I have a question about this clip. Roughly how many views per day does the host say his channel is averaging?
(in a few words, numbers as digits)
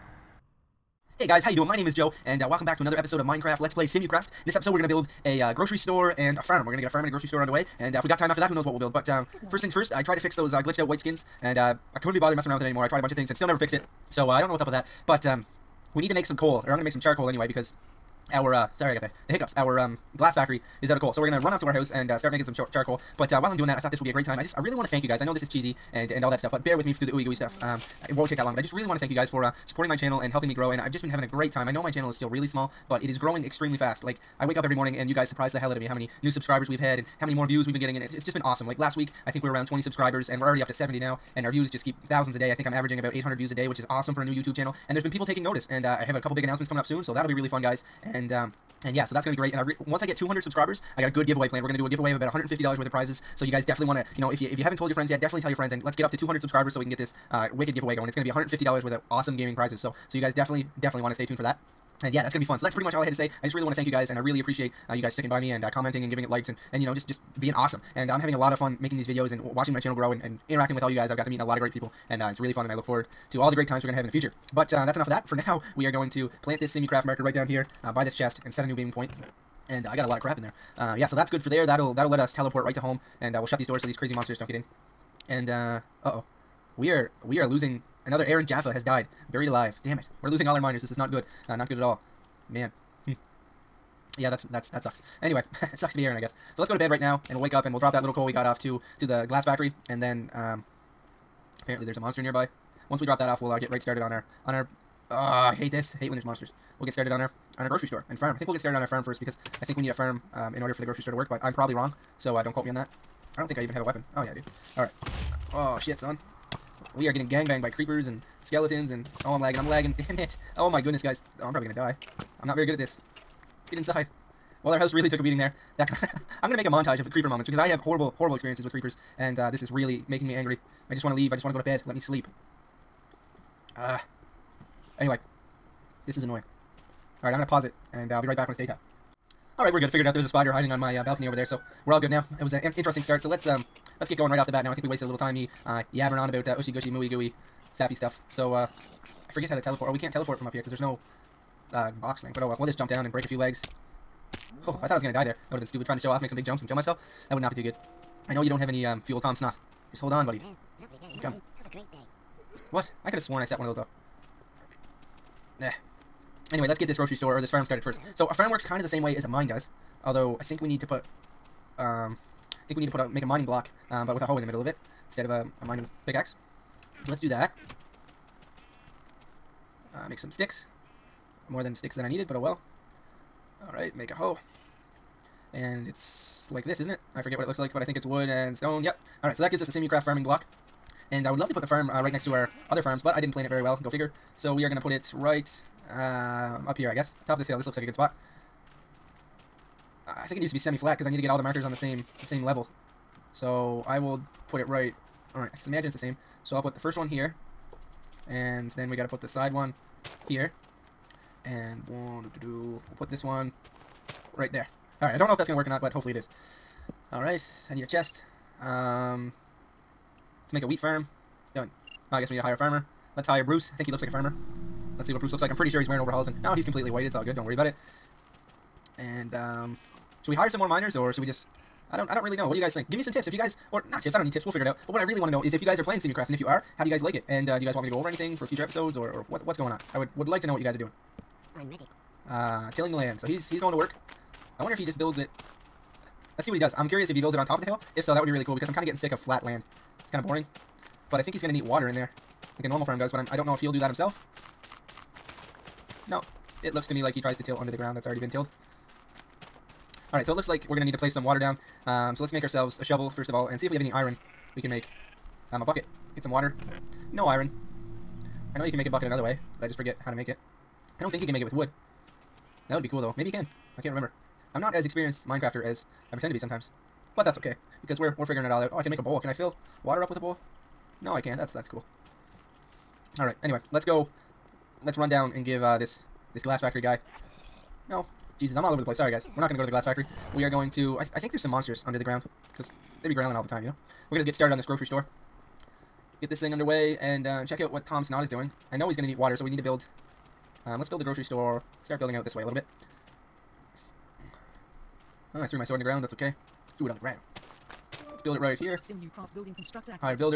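800.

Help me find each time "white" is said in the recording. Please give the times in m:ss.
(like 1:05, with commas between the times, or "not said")
0:10, 3:46.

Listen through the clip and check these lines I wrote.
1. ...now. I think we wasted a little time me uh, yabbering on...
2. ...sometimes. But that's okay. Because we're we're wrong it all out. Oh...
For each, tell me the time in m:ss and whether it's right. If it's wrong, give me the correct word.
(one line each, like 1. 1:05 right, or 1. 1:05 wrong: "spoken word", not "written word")
1. 2:24 right
2. 4:36 wrong: "figuring", not "wrong".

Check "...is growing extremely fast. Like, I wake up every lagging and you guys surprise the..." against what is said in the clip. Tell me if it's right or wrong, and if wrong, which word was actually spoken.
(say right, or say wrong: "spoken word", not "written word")
wrong: "morning", not "lagging".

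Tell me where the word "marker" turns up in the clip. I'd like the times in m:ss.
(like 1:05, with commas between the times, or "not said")
1:17, 3:21.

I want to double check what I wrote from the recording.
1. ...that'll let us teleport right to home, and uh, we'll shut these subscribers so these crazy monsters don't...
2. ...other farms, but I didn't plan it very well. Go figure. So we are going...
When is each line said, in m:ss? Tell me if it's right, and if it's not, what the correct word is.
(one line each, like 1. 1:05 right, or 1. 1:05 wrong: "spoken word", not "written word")
1. 1:21 wrong: "doors", not "subscribers"
2. 3:12 right.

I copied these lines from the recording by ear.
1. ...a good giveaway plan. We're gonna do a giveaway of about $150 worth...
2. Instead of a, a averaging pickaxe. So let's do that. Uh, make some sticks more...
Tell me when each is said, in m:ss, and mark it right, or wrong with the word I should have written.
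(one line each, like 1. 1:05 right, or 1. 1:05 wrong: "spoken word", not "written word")
1. 0:51 right
2. 2:55 wrong: "mining", not "averaging".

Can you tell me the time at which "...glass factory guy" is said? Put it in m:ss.
4:46.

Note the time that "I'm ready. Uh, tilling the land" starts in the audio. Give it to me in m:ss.
4:01.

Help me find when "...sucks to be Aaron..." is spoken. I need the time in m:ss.
1:35.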